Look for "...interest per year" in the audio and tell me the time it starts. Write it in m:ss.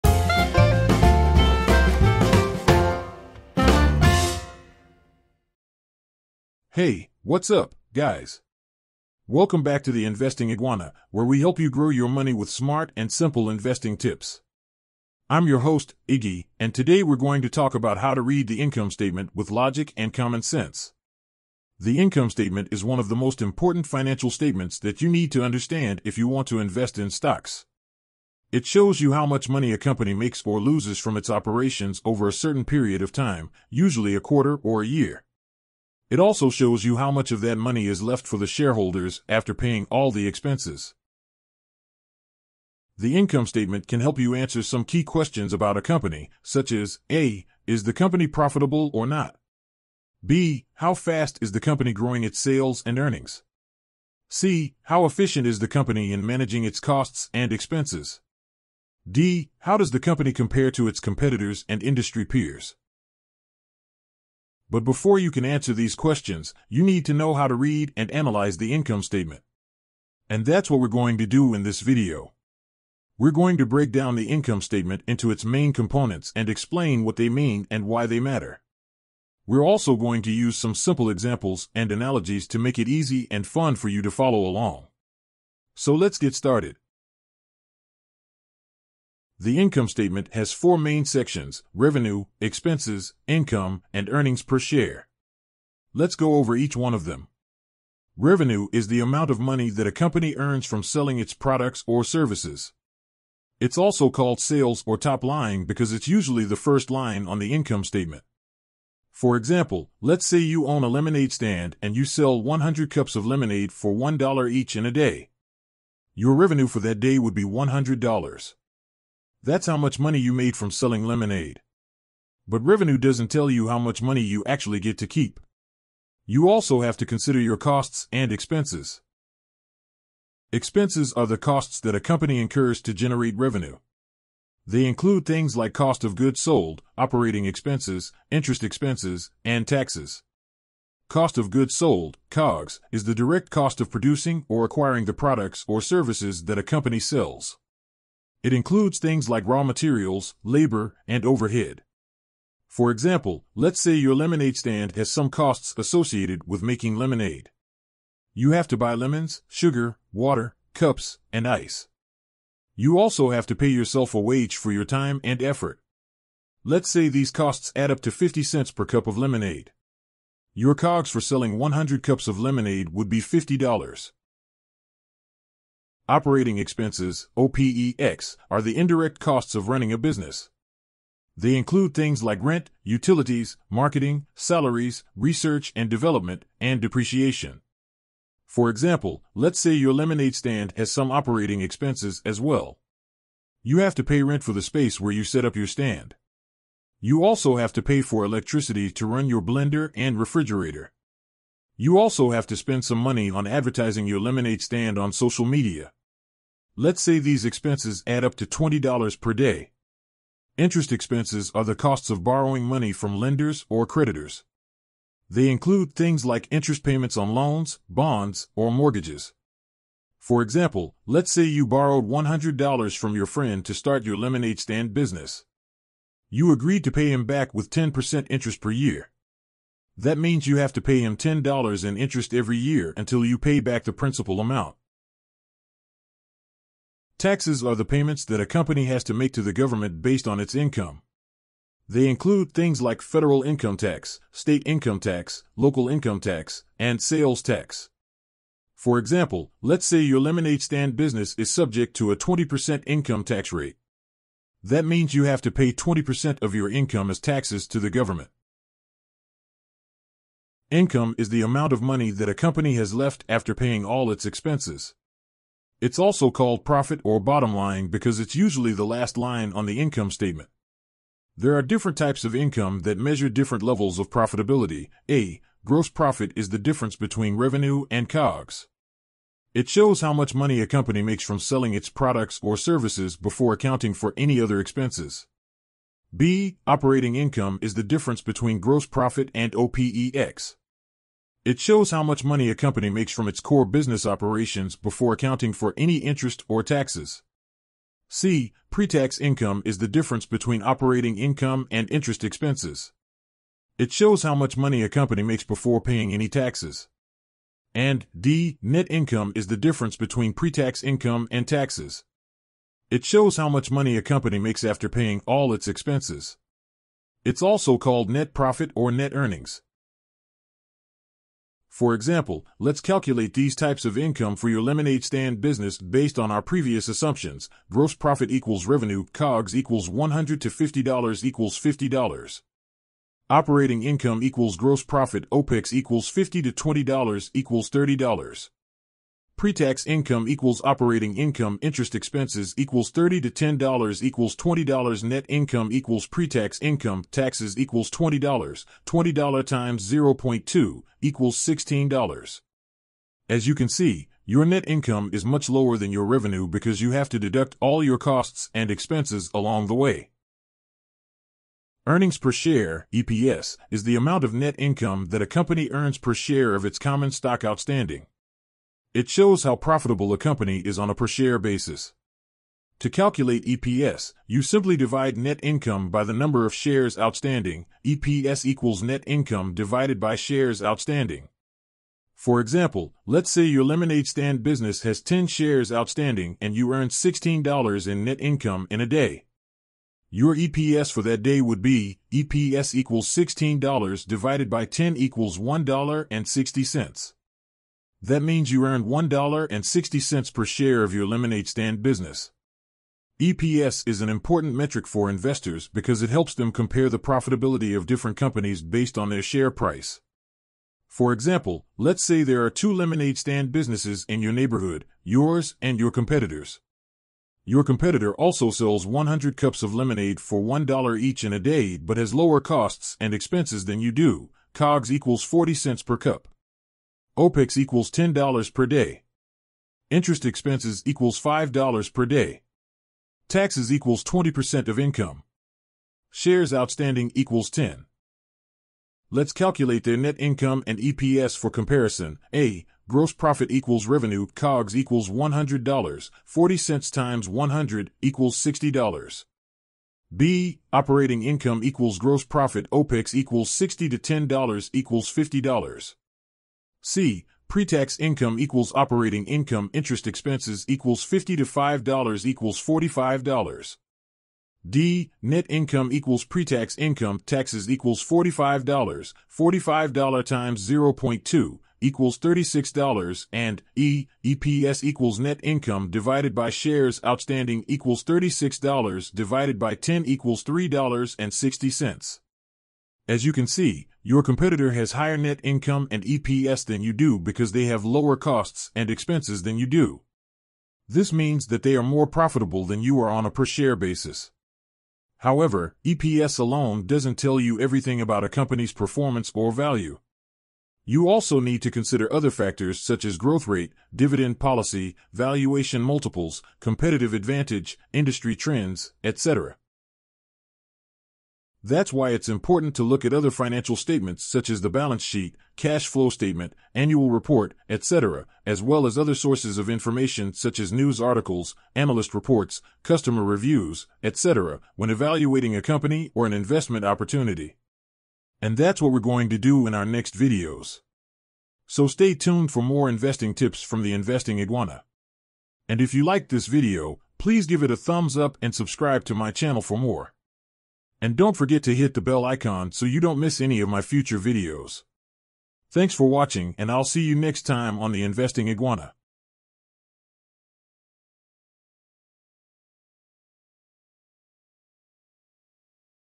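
3:48.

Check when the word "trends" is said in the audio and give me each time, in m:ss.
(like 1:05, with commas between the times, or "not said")
8:28.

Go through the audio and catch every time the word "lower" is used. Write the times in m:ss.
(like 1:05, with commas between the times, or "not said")
5:55, 7:02, 8:07.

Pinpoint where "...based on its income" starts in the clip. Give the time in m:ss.
4:00.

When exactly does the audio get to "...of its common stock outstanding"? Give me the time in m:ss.
6:06.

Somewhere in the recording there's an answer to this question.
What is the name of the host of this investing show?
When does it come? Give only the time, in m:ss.
0:16.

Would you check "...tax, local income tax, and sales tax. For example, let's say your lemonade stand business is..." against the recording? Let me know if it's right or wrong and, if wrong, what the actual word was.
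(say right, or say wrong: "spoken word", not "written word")
right.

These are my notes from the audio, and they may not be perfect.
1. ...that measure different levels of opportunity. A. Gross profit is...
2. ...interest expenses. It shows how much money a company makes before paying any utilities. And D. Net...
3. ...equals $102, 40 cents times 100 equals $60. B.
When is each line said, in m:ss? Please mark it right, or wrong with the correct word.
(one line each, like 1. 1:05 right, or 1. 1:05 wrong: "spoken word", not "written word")
1. 4:32 wrong: "profitability", not "opportunity"
2. 5:01 wrong: "taxes", not "utilities"
3. 7:24 wrong: "100", not "102".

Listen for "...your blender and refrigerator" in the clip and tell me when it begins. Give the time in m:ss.
3:19.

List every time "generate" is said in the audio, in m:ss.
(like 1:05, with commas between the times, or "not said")
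2:12.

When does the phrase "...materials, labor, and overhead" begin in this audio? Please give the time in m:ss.
2:29.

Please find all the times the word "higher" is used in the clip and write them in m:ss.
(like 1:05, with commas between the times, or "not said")
8:04.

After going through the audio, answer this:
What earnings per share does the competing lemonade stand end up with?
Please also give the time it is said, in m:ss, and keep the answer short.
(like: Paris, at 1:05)
$3.60, at 8:00.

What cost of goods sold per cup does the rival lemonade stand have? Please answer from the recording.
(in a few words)
40 cents.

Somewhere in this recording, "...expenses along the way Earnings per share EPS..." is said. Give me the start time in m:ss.
5:58.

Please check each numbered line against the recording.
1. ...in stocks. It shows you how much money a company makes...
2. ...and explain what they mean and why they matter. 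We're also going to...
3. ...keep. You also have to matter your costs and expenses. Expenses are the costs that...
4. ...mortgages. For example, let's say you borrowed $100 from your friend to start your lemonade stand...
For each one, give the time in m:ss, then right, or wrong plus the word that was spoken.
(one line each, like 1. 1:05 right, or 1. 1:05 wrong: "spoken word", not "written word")
1. 0:26 right
2. 1:16 right
3. 2:05 wrong: "consider", not "matter"
4. 3:38 right.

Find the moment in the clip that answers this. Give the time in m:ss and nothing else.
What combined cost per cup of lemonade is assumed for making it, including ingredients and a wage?
2:48.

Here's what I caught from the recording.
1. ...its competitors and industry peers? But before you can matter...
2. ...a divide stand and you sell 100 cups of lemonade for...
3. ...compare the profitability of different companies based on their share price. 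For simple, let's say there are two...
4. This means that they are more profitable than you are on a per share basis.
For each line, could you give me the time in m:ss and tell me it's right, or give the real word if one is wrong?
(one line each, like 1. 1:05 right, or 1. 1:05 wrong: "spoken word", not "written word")
1. 1:00 wrong: "answer", not "matter"
2. 1:50 wrong: "lemonade", not "divide"
3. 6:46 wrong: "example", not "simple"
4. 8:10 right.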